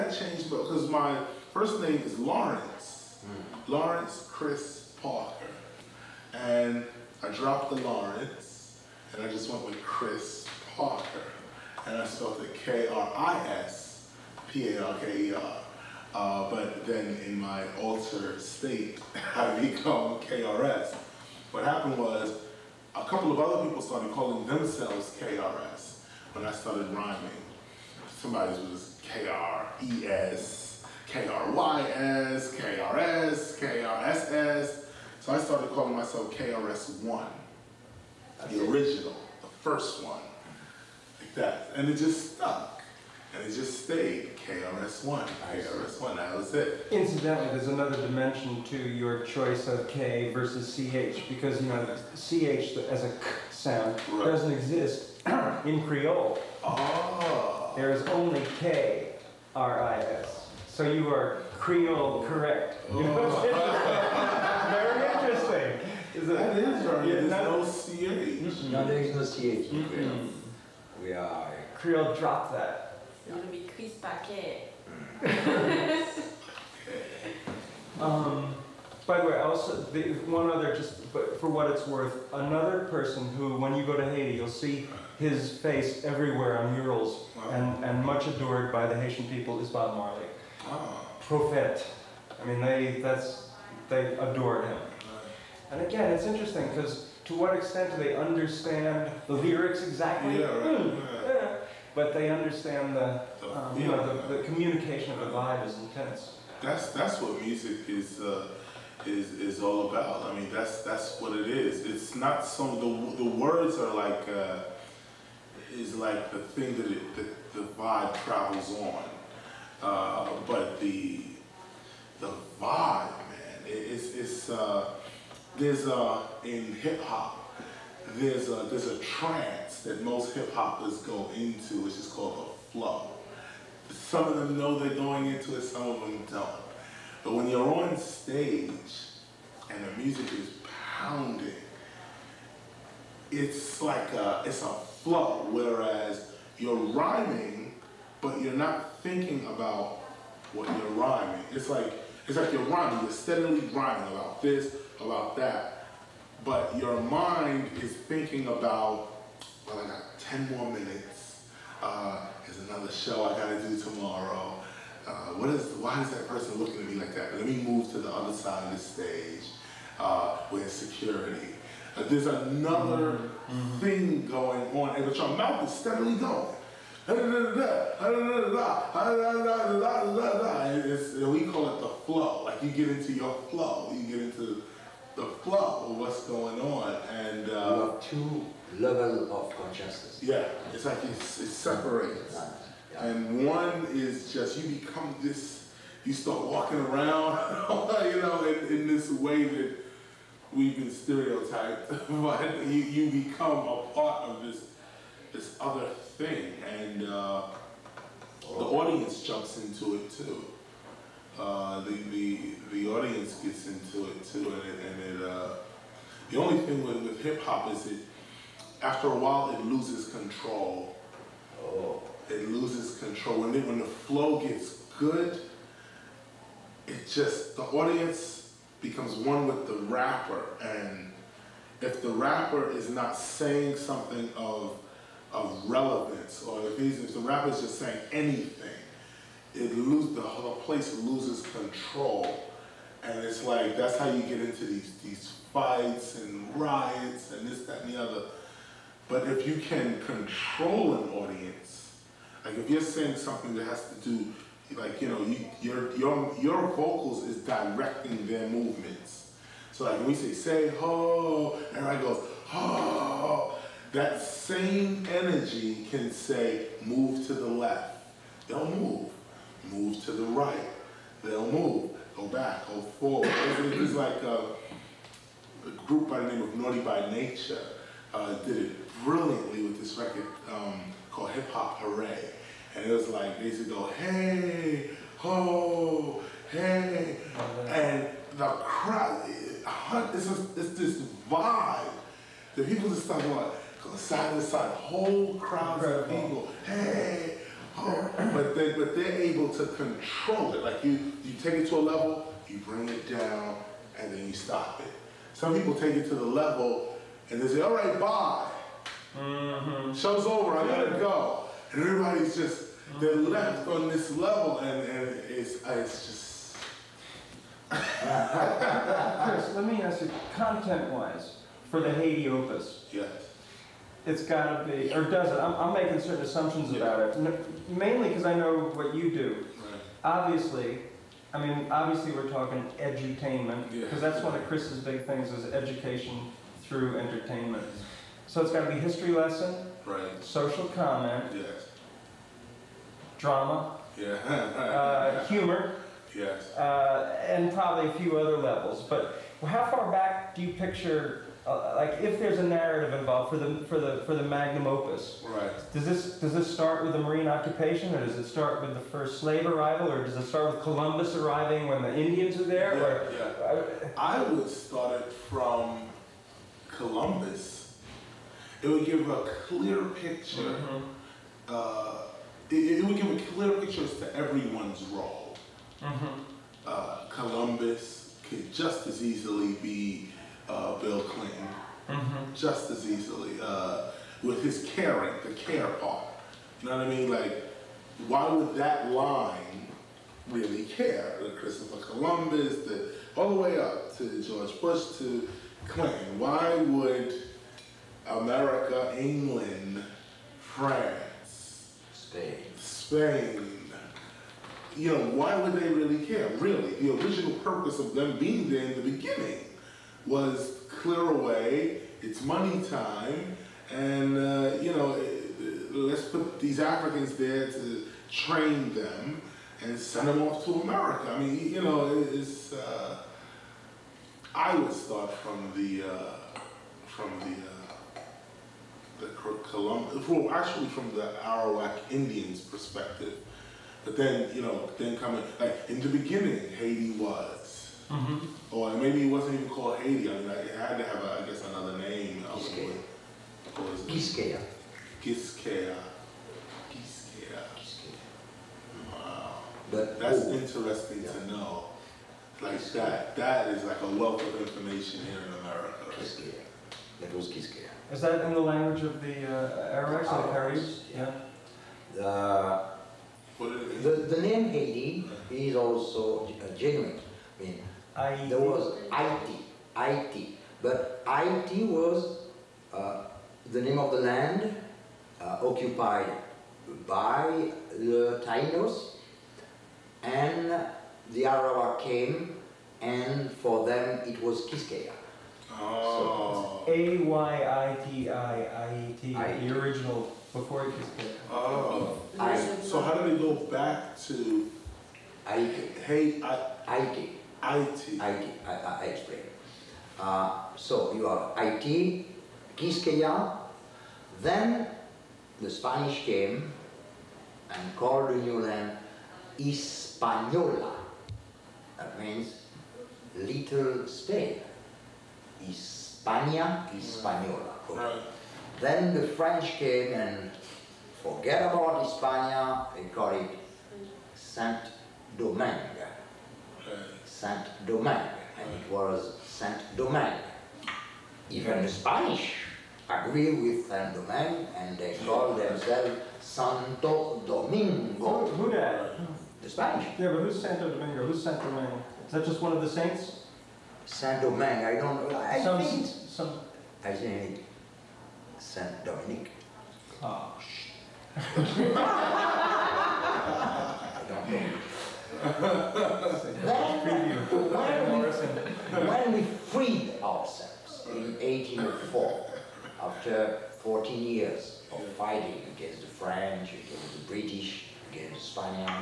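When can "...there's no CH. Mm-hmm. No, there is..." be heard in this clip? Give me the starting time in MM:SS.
01:07.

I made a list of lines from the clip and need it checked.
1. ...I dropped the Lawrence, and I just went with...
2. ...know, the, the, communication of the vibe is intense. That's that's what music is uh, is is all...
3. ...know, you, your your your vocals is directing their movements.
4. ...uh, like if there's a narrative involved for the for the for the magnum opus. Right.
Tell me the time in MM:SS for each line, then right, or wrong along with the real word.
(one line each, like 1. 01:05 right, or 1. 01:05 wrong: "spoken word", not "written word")
1. 00:07 right
2. 01:43 right
3. 04:15 right
4. 05:51 right.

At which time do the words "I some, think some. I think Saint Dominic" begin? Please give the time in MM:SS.
09:05.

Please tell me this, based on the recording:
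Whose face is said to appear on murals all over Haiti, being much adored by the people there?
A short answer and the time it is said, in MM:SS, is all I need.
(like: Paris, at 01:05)
Bob Marley, at 01:29.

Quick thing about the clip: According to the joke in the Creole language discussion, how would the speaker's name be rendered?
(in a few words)
Chris Paquet.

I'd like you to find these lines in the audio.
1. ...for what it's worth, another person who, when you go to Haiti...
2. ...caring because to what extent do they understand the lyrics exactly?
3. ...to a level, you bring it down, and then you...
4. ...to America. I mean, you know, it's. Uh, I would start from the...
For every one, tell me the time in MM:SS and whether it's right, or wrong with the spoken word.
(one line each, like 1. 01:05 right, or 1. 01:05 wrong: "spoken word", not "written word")
1. 01:21 right
2. 01:36 wrong: "interesting", not "caring"
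3. 05:01 right
4. 07:00 right.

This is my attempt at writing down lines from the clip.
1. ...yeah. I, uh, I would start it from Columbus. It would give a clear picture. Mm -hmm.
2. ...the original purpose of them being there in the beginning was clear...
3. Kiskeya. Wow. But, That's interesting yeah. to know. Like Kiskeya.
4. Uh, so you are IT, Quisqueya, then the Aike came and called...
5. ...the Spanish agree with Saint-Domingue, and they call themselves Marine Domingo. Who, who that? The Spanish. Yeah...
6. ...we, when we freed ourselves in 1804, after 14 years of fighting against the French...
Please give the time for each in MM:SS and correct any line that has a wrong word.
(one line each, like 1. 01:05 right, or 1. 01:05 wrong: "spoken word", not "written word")
1. 06:03 right
2. 06:46 right
3. 07:26 right
4. 08:19 wrong: "Spanish", not "Aike"
5. 08:51 wrong: "Santo", not "Marine"
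6. 09:18 right.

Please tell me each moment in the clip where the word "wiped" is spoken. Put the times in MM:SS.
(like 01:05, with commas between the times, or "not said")
not said.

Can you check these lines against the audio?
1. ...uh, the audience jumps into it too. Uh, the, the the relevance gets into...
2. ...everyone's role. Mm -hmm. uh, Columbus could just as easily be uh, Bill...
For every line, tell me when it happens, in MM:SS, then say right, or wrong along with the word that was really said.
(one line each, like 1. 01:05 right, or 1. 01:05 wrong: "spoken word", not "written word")
1. 03:27 wrong: "audience", not "relevance"
2. 06:14 right.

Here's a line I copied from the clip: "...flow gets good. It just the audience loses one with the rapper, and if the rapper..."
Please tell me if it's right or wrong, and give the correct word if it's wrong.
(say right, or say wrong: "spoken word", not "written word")
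wrong: "becomes", not "loses".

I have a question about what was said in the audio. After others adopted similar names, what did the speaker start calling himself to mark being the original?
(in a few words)
KRS1.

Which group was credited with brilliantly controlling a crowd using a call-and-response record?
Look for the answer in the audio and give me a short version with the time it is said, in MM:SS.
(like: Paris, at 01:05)
Naughty by Nature, at 04:36.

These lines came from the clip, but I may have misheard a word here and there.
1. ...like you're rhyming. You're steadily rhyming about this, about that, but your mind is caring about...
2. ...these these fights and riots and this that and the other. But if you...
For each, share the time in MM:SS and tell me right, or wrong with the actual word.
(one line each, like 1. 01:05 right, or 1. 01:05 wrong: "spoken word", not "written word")
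1. 02:32 wrong: "thinking", not "caring"
2. 04:04 right.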